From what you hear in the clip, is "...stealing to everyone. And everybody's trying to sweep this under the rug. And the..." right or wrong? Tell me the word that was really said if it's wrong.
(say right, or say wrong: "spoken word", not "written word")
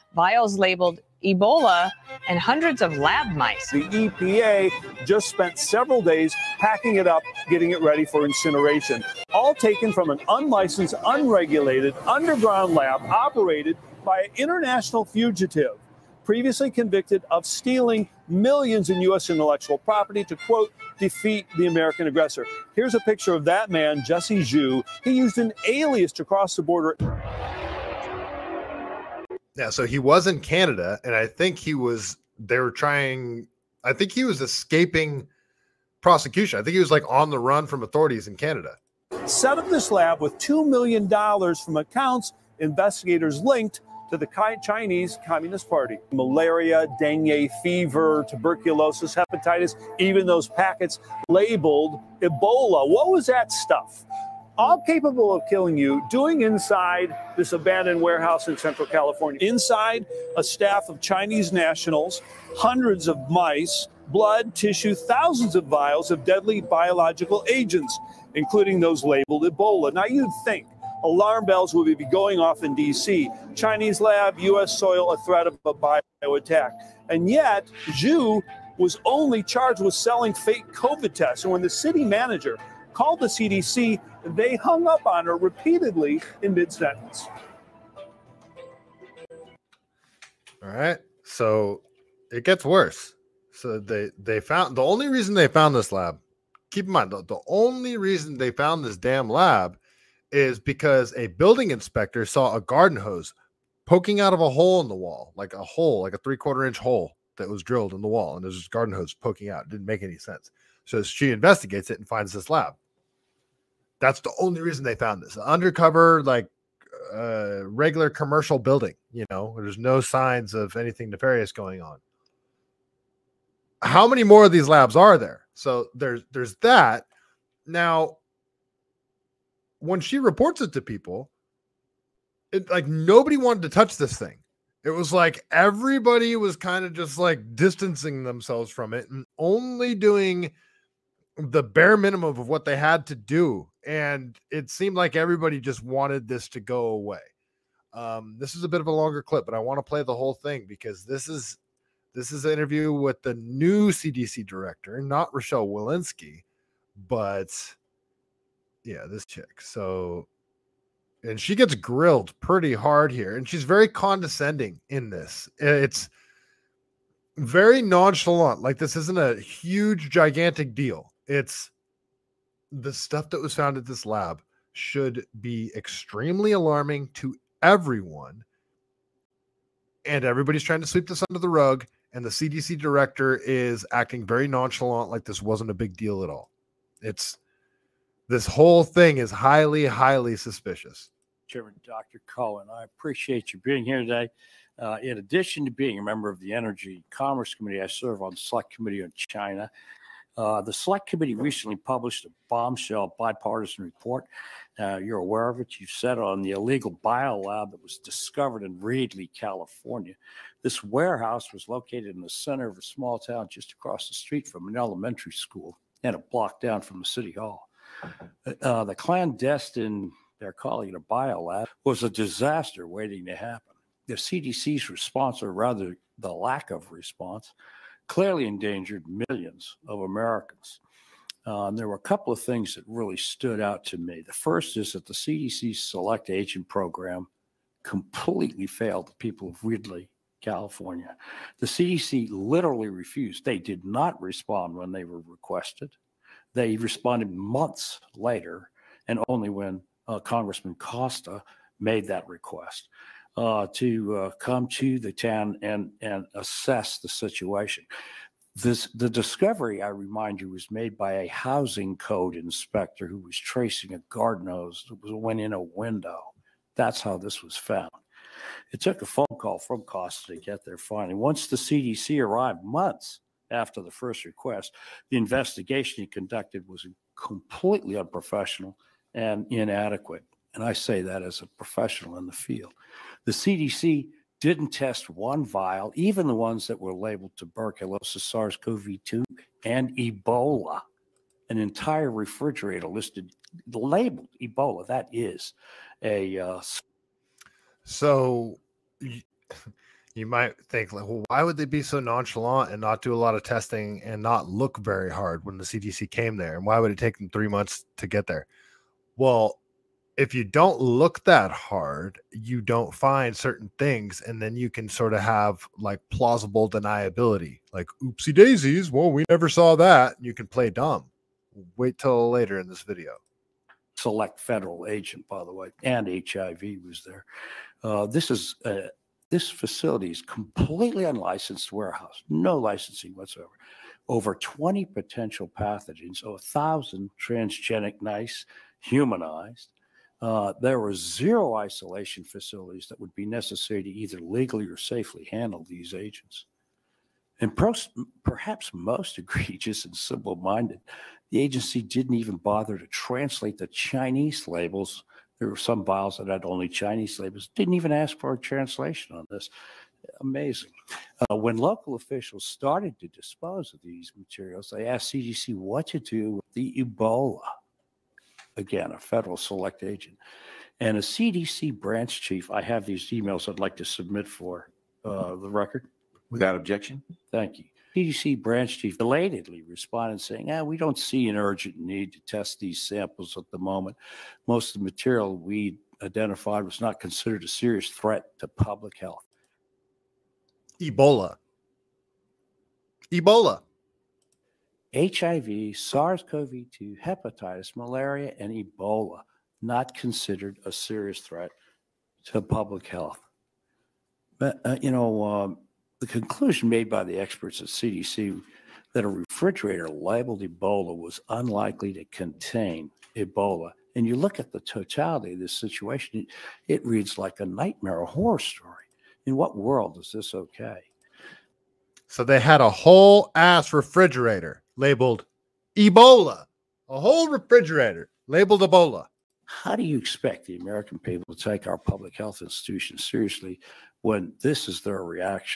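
wrong: "alarming", not "stealing".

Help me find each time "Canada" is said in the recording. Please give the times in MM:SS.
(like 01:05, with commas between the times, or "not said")
00:30, 00:38.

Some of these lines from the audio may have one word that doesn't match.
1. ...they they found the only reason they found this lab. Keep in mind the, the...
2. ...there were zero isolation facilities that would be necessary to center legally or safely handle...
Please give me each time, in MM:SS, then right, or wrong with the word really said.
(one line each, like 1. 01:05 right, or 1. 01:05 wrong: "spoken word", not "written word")
1. 01:33 right
2. 05:40 wrong: "either", not "center".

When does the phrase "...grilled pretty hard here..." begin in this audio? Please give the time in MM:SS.
02:41.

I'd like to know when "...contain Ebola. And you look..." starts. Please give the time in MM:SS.
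06:52.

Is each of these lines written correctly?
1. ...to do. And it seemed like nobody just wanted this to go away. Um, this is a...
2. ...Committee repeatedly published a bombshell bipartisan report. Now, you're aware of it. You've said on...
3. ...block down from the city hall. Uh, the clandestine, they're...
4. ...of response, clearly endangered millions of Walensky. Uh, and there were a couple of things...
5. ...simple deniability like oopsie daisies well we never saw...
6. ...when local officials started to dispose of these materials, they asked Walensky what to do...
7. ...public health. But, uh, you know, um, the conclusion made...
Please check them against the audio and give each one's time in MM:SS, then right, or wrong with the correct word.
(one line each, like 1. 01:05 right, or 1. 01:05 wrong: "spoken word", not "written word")
1. 02:23 wrong: "everybody", not "nobody"
2. 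03:21 wrong: "recently", not "repeatedly"
3. 03:36 right
4. 03:46 wrong: "Americans", not "Walensky"
5. 05:16 wrong: "plausible", not "simple"
6. 06:01 wrong: "CDC", not "Walensky"
7. 06:42 right.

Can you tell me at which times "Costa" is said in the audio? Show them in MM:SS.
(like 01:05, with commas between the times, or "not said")
04:10, 04:29.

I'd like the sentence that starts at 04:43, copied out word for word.
The CDC didn't test one vial, even the ones that were labeled tuberculosis, SARS CoV 2, and Ebola.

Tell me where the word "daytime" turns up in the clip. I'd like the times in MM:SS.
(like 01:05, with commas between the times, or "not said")
not said.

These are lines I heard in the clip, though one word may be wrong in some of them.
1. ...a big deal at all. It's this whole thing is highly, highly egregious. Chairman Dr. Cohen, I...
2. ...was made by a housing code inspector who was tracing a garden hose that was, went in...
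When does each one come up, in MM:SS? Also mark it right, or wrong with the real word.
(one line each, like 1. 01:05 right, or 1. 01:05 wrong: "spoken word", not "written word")
1. 03:05 wrong: "suspicious", not "egregious"
2. 04:20 right.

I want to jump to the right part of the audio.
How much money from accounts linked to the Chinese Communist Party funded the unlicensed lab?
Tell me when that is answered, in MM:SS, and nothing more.
00:40.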